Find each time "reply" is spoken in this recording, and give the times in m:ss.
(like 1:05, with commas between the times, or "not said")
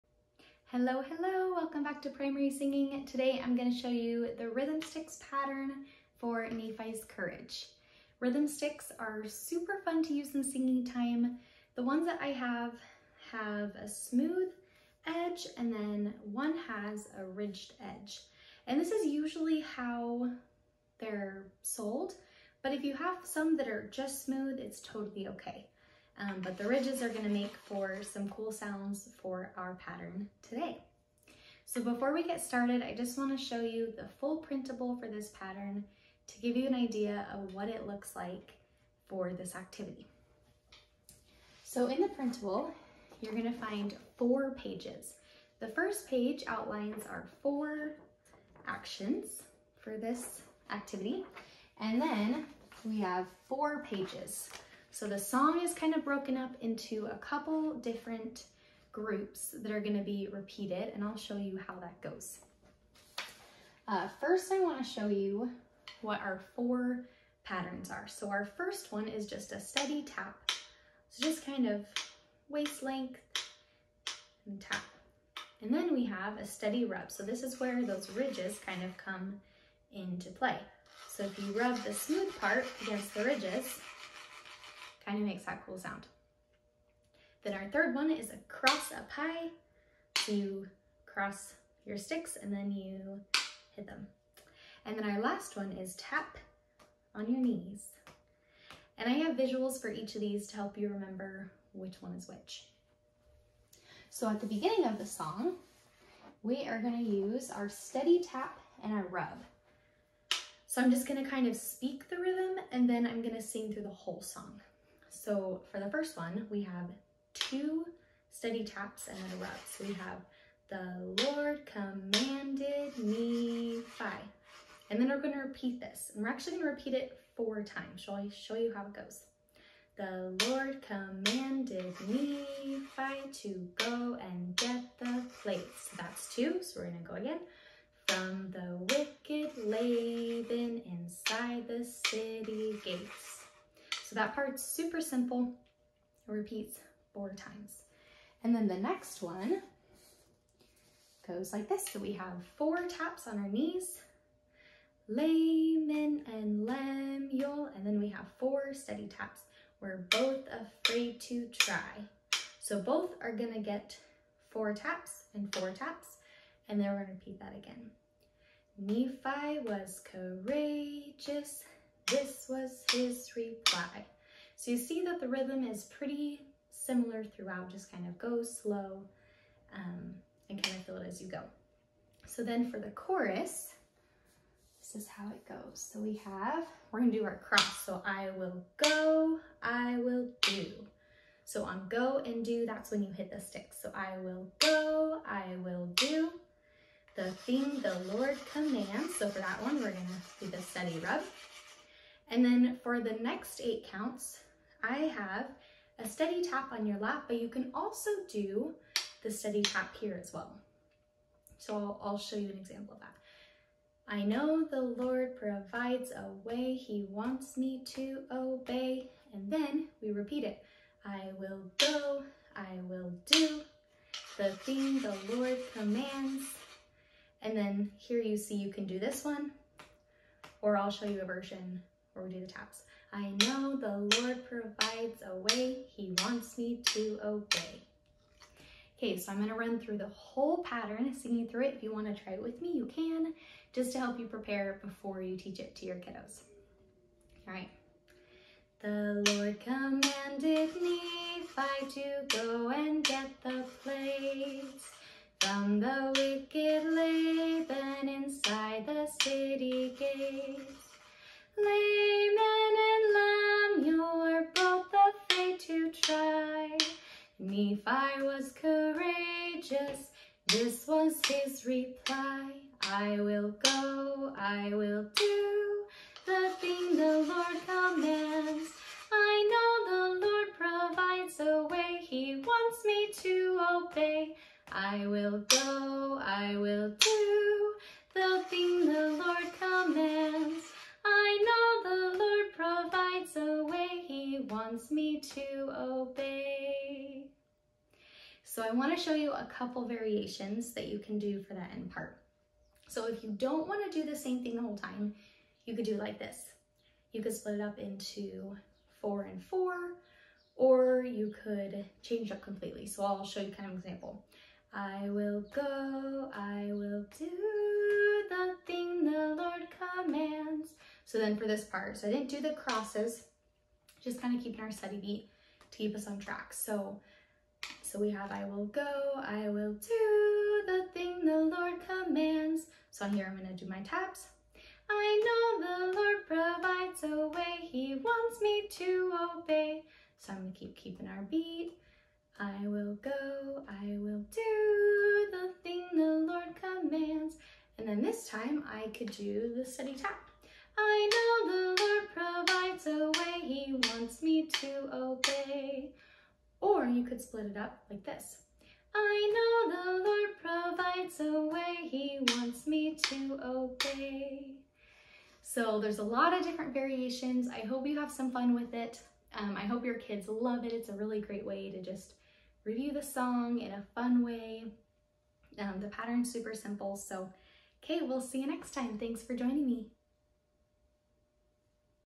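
2:53, 4:31.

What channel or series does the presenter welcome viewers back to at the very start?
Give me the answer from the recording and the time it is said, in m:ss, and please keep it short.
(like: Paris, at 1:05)
Primary Singing, at 0:02.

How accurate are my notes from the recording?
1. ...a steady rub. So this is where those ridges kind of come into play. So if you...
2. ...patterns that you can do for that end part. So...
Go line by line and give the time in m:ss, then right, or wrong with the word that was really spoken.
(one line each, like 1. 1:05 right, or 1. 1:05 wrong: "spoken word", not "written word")
1. 1:16 right
2. 4:59 wrong: "variations", not "patterns".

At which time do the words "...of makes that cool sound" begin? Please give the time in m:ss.
1:25.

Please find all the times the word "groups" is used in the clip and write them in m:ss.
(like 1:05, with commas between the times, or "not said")
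0:58.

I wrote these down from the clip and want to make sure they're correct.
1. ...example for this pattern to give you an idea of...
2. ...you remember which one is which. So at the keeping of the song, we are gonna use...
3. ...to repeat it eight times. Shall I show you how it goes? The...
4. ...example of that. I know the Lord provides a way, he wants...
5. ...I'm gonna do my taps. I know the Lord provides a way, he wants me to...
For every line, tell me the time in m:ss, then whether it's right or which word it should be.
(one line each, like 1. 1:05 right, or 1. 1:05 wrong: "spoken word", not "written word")
1. 0:34 wrong: "printable", not "example"
2. 1:40 wrong: "beginning", not "keeping"
3. 2:06 wrong: "four", not "eight"
4. 3:32 right
5. 5:33 right.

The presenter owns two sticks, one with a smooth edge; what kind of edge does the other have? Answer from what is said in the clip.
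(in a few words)
Ridged edge.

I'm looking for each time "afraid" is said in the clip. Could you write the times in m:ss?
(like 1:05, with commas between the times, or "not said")
2:40, 4:25.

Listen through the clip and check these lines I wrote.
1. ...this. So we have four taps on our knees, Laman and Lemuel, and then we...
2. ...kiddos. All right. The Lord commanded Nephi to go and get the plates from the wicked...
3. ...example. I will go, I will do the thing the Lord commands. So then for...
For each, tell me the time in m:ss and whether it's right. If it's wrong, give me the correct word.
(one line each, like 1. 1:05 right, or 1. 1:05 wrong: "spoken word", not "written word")
1. 2:31 right
2. 4:05 right
3. 5:13 right.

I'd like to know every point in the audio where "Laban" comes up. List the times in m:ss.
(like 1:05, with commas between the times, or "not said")
2:19, 4:16.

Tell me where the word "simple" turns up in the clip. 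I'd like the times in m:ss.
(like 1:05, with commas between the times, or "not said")
2:24, 6:16.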